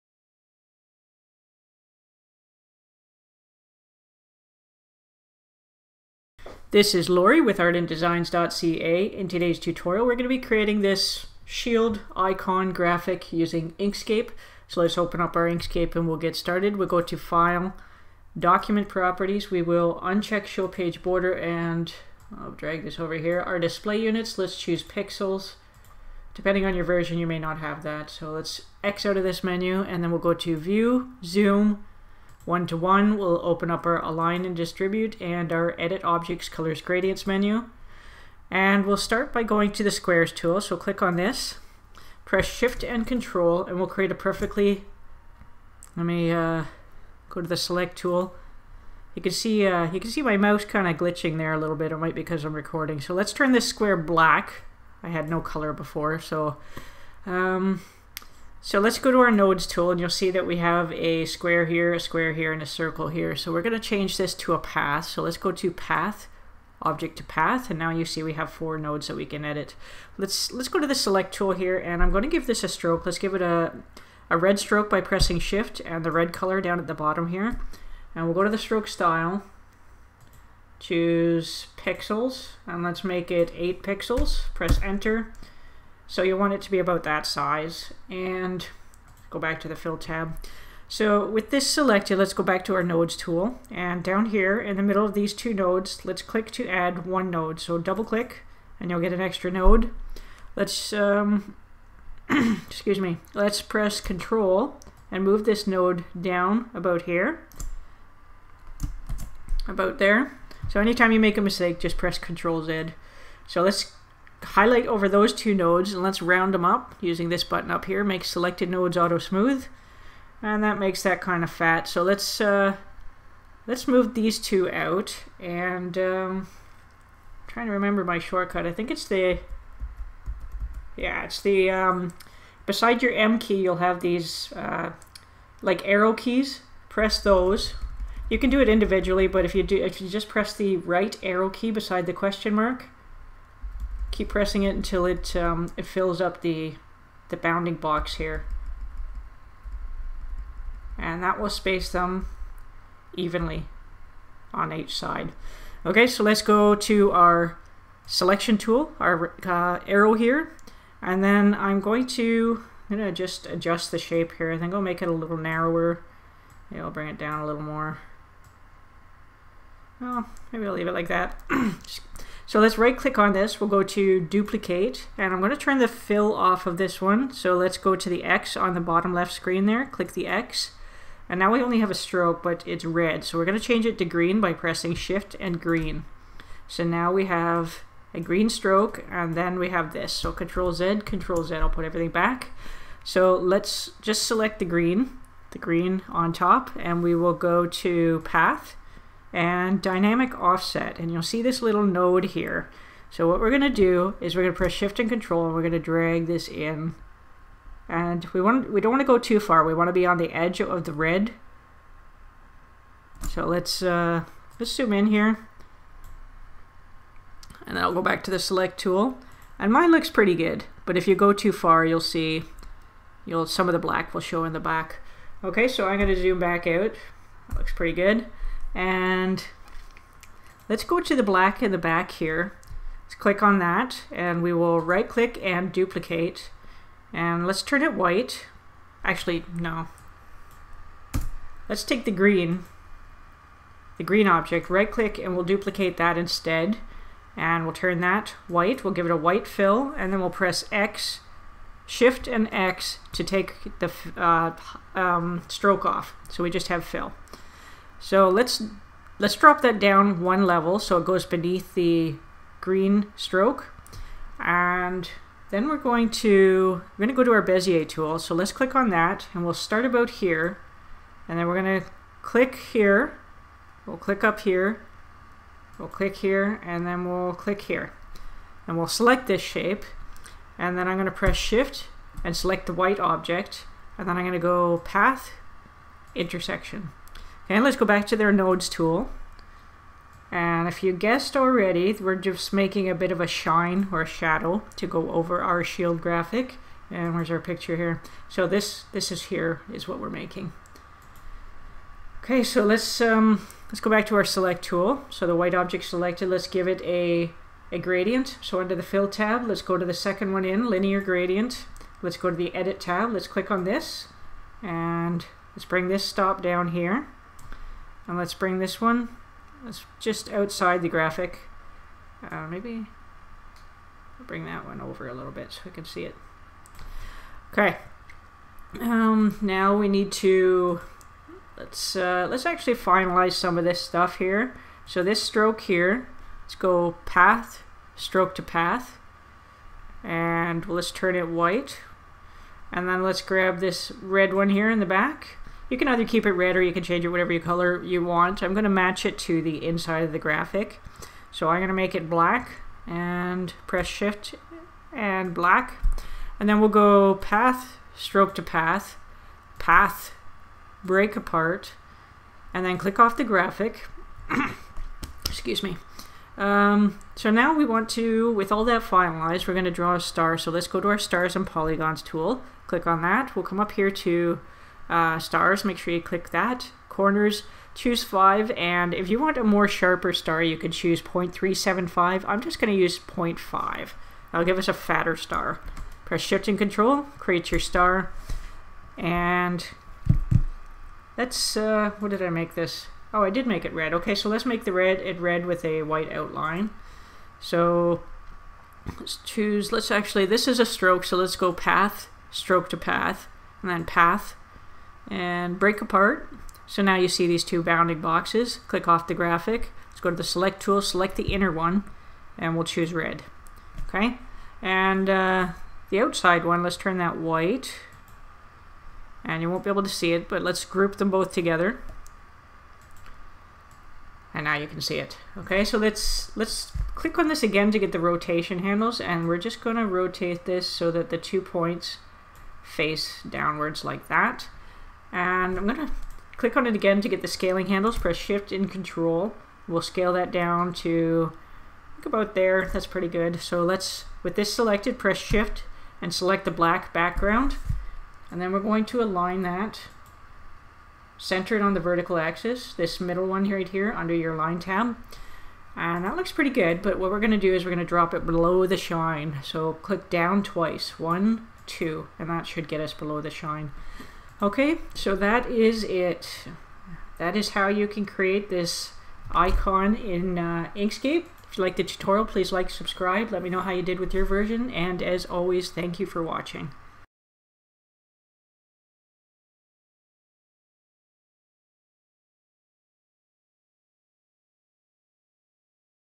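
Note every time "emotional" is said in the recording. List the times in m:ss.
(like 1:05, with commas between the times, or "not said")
not said.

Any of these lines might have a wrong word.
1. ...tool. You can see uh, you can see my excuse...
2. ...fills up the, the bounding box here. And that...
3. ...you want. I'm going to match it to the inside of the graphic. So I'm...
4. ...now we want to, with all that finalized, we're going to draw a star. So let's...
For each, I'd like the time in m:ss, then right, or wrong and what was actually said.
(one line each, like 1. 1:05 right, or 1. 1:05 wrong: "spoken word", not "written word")
1. 0:47 wrong: "mouse", not "excuse"
2. 2:25 right
3. 5:47 right
4. 6:07 right.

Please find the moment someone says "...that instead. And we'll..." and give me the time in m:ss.
4:05.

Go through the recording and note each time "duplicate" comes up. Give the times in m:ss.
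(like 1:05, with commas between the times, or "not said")
2:54, 3:55, 4:05.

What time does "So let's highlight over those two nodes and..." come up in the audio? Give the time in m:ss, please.
1:53.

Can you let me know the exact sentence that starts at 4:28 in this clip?
So let's click on that and we'll start about here.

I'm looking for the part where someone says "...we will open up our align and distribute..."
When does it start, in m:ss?
0:33.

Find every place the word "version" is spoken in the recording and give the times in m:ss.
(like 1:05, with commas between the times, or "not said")
0:26, 7:54.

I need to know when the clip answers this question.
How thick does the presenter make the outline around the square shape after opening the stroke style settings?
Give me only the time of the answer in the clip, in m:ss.
1:23.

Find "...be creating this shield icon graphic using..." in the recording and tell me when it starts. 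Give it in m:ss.
0:10.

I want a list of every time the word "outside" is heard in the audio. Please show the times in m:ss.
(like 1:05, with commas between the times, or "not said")
5:20, 6:55.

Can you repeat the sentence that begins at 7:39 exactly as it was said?
So click down twice, one, two, and that should get us below the shine.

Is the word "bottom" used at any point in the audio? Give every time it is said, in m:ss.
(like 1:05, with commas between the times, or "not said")
1:16, 2:58.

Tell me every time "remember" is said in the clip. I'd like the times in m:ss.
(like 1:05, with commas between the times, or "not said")
2:07.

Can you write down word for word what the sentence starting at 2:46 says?
Yeah, I'll bring it down a little more.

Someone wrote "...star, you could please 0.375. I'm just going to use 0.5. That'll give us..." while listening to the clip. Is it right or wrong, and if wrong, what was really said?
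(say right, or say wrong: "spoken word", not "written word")
wrong: "choose", not "please".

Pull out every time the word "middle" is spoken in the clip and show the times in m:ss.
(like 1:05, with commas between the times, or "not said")
1:34, 7:32.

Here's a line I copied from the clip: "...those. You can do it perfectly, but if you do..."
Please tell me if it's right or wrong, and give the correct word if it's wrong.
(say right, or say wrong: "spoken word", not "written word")
wrong: "individually", not "perfectly".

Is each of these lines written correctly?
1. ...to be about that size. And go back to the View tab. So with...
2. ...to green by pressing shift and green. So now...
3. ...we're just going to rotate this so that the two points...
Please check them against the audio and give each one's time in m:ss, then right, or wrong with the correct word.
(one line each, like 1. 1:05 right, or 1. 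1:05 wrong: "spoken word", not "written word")
1. 1:26 wrong: "Fill", not "View"
2. 3:03 right
3. 7:09 right.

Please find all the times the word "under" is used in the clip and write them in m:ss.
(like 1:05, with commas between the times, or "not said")
5:08, 7:33.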